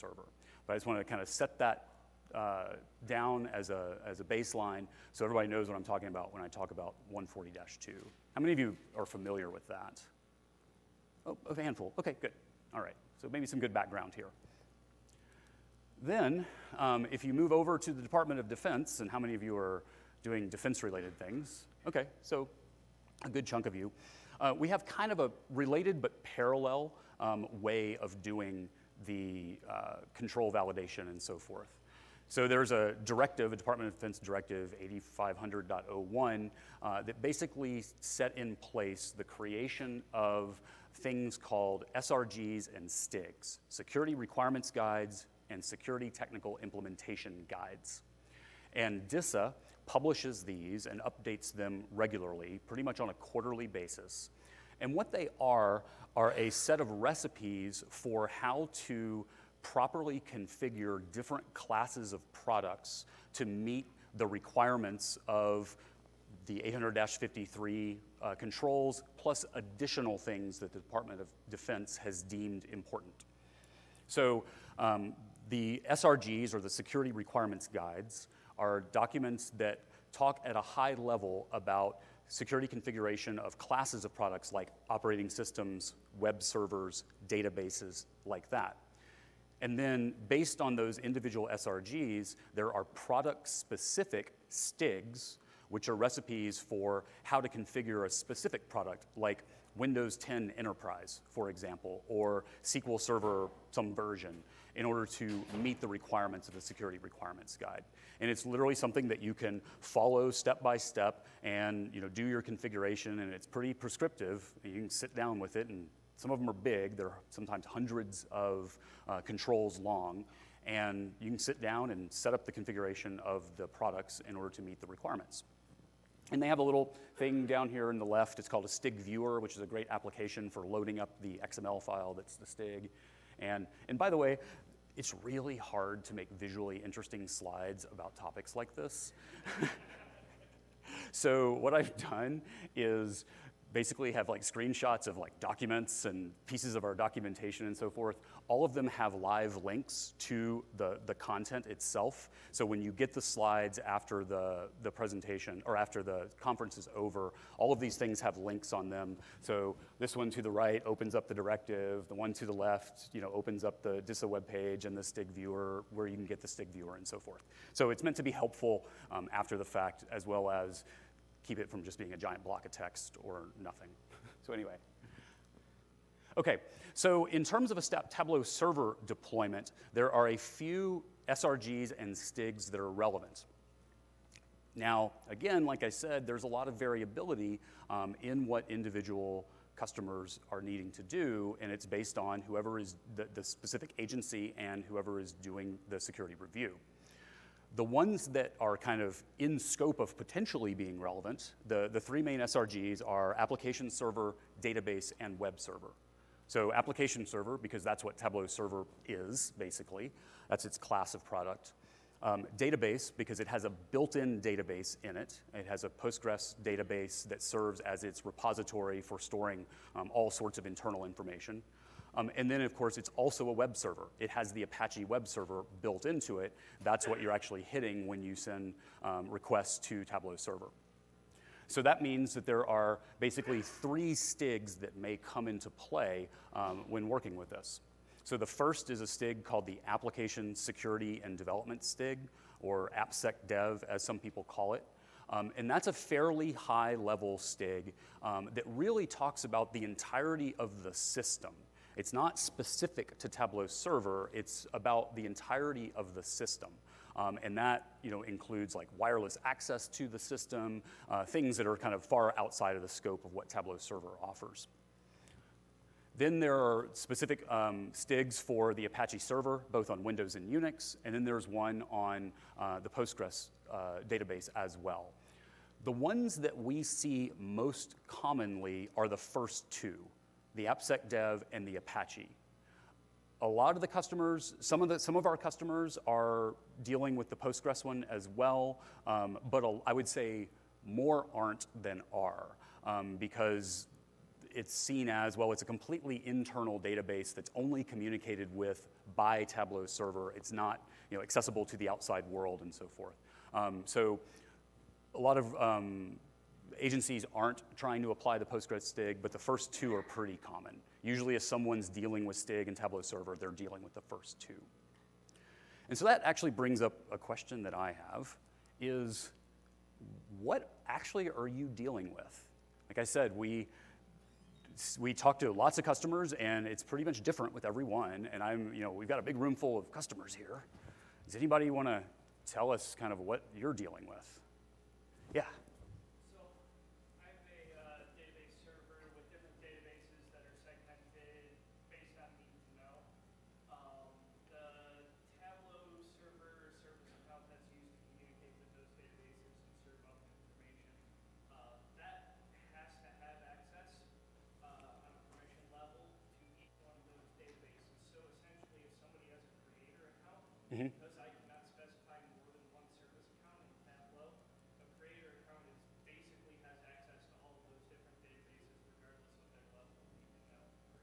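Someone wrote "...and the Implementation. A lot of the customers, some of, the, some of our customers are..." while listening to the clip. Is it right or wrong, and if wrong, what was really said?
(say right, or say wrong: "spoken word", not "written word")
wrong: "Apache", not "Implementation".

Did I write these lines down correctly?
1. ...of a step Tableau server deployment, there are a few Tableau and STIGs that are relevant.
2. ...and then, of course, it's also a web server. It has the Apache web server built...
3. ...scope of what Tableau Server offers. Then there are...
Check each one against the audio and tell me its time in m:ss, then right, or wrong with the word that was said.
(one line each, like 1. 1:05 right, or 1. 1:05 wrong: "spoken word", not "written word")
1. 2:57 wrong: "SRGs", not "Tableau"
2. 3:42 right
3. 4:22 right.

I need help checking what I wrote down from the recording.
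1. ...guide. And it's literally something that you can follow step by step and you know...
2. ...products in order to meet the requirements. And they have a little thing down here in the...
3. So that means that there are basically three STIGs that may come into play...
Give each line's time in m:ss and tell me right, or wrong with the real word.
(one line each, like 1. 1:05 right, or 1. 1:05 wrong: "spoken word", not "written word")
1. 1:47 right
2. 2:03 right
3. 3:51 right.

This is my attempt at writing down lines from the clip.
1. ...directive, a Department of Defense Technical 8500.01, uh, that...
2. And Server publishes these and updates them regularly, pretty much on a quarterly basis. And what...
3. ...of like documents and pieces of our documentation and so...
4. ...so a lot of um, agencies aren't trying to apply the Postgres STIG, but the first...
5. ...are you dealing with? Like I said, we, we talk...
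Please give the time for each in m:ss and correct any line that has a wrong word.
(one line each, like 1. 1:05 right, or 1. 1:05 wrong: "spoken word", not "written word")
1. 0:33 wrong: "Directive", not "Technical"
2. 0:48 wrong: "DISA", not "Server"
3. 2:25 right
4. 5:03 right
5. 5:21 right.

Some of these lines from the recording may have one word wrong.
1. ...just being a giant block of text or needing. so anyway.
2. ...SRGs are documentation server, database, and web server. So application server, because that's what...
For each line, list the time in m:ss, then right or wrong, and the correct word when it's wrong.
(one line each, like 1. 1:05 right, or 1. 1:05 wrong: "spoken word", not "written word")
1. 2:51 wrong: "nothing", not "needing"
2. 3:22 wrong: "application", not "documentation".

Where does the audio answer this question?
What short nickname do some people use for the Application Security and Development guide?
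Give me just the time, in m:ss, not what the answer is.
4:02.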